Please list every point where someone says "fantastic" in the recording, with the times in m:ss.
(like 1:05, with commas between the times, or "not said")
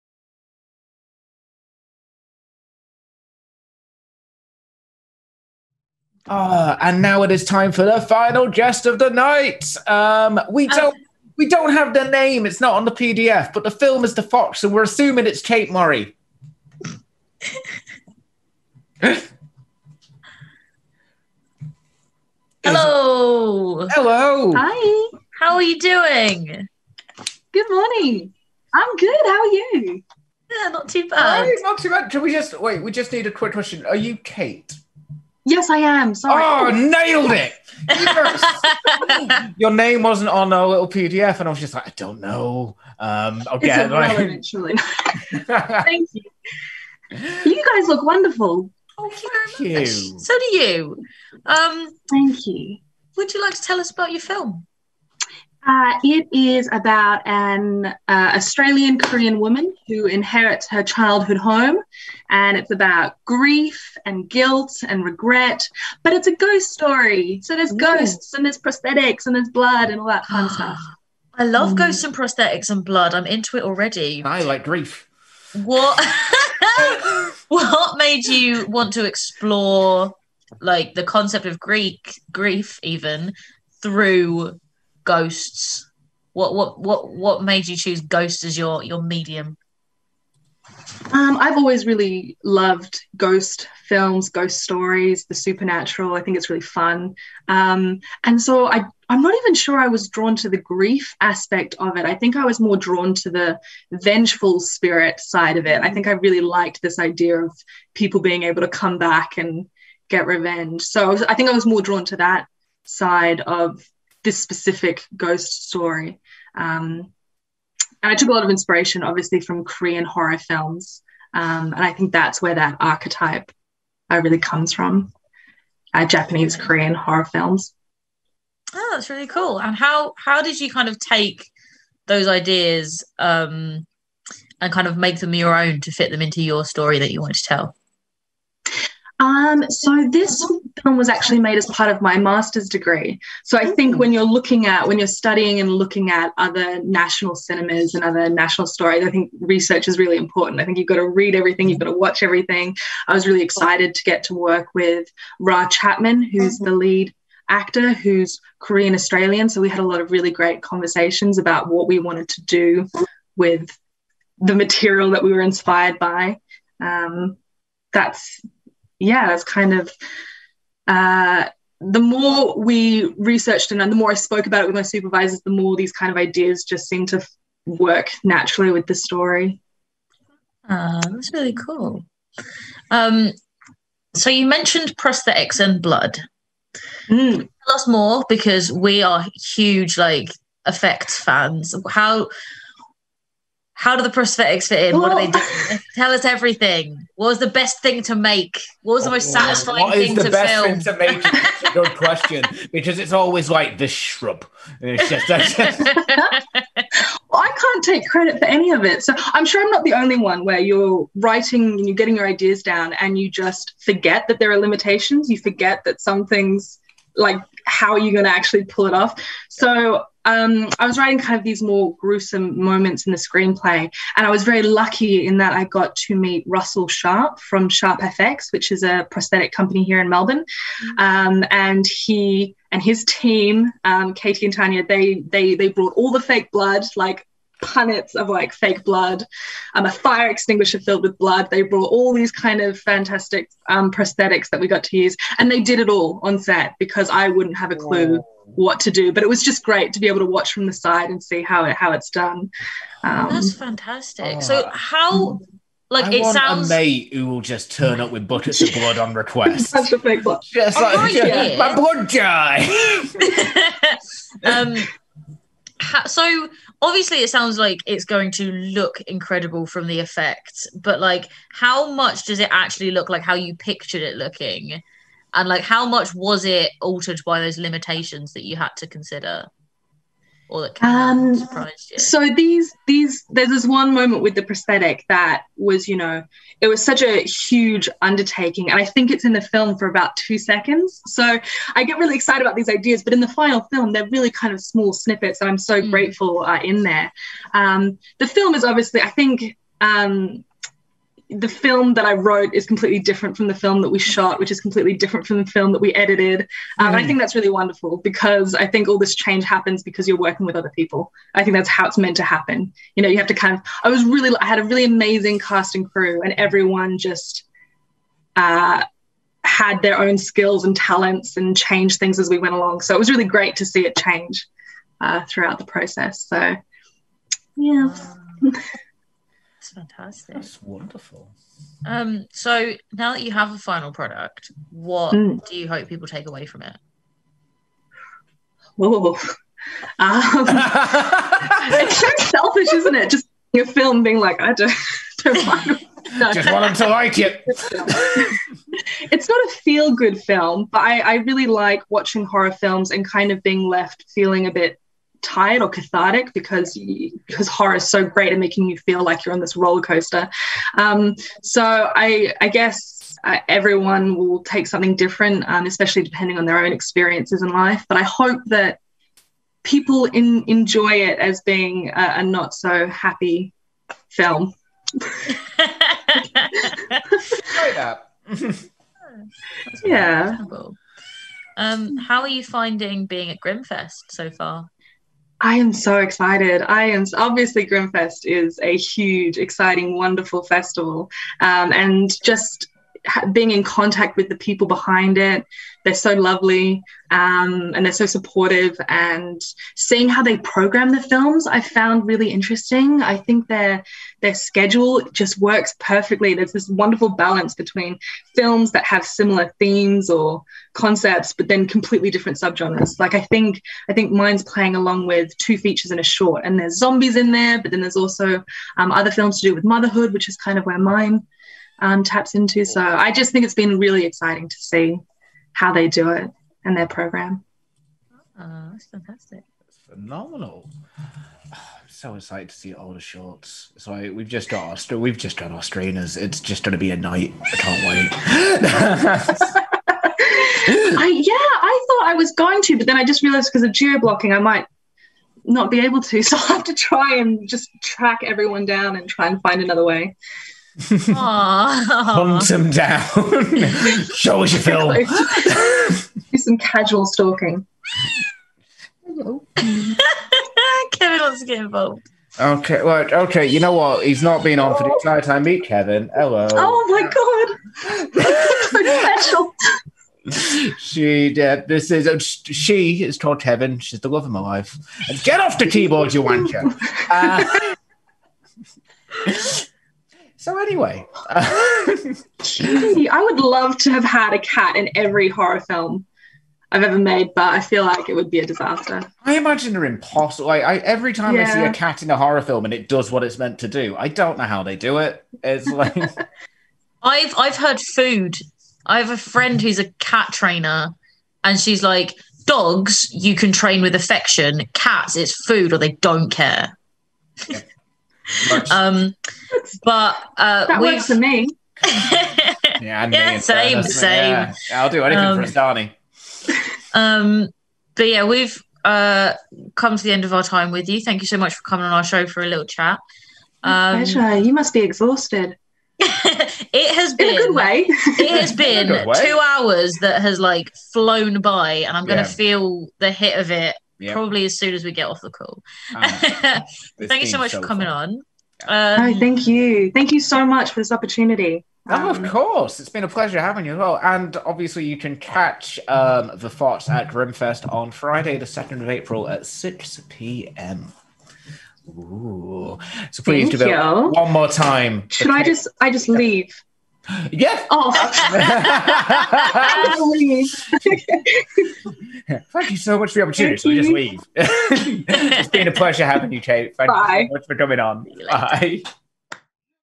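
4:02, 4:13, 5:29, 7:08.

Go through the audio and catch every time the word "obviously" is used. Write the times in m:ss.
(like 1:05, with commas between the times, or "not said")
1:59, 4:26, 4:58, 6:27, 9:04.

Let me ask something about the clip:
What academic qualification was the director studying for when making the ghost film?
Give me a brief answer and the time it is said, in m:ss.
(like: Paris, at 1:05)
Master's degree, at 2:22.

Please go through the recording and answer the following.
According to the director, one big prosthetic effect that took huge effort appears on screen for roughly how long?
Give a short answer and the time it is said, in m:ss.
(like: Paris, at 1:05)
2 seconds, at 4:50.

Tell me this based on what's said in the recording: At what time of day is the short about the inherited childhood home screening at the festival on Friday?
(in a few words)
6 p.m.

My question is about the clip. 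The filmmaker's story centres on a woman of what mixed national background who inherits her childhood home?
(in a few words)
Australian Korean.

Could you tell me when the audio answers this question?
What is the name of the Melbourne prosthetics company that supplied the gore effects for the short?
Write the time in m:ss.
3:47.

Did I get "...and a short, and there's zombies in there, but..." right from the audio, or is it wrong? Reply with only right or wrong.
right.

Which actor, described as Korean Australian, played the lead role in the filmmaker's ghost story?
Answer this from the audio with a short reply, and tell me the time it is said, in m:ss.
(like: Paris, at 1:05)
Ra Chapman, at 2:35.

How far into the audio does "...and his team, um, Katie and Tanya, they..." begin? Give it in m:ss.
3:52.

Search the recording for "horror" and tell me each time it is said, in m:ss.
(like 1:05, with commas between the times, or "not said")
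2:00, 2:06, 5:52, 5:57, 8:05, 8:12.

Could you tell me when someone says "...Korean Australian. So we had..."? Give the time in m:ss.
2:38.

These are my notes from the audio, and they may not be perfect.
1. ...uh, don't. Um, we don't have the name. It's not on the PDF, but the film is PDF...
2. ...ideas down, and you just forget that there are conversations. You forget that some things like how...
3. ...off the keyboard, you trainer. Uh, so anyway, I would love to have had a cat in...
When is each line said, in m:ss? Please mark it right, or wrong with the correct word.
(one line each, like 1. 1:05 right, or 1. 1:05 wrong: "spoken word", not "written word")
1. 0:10 wrong: "The", not "PDF"
2. 3:32 wrong: "limitations", not "conversations"
3. 7:55 wrong: "wanker", not "trainer".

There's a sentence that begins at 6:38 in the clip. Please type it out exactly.
And seeing how they program the films, I found really interesting.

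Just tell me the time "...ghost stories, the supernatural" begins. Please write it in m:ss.
1:34.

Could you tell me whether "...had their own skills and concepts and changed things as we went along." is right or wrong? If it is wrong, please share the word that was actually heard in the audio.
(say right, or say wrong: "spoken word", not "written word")
wrong: "talents", not "concepts".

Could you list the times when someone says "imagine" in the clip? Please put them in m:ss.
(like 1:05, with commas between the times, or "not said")
8:09.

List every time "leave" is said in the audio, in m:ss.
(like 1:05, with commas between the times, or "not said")
9:16, 9:23.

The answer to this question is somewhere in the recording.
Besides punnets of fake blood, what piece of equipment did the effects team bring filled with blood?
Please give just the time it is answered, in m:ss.
3:59.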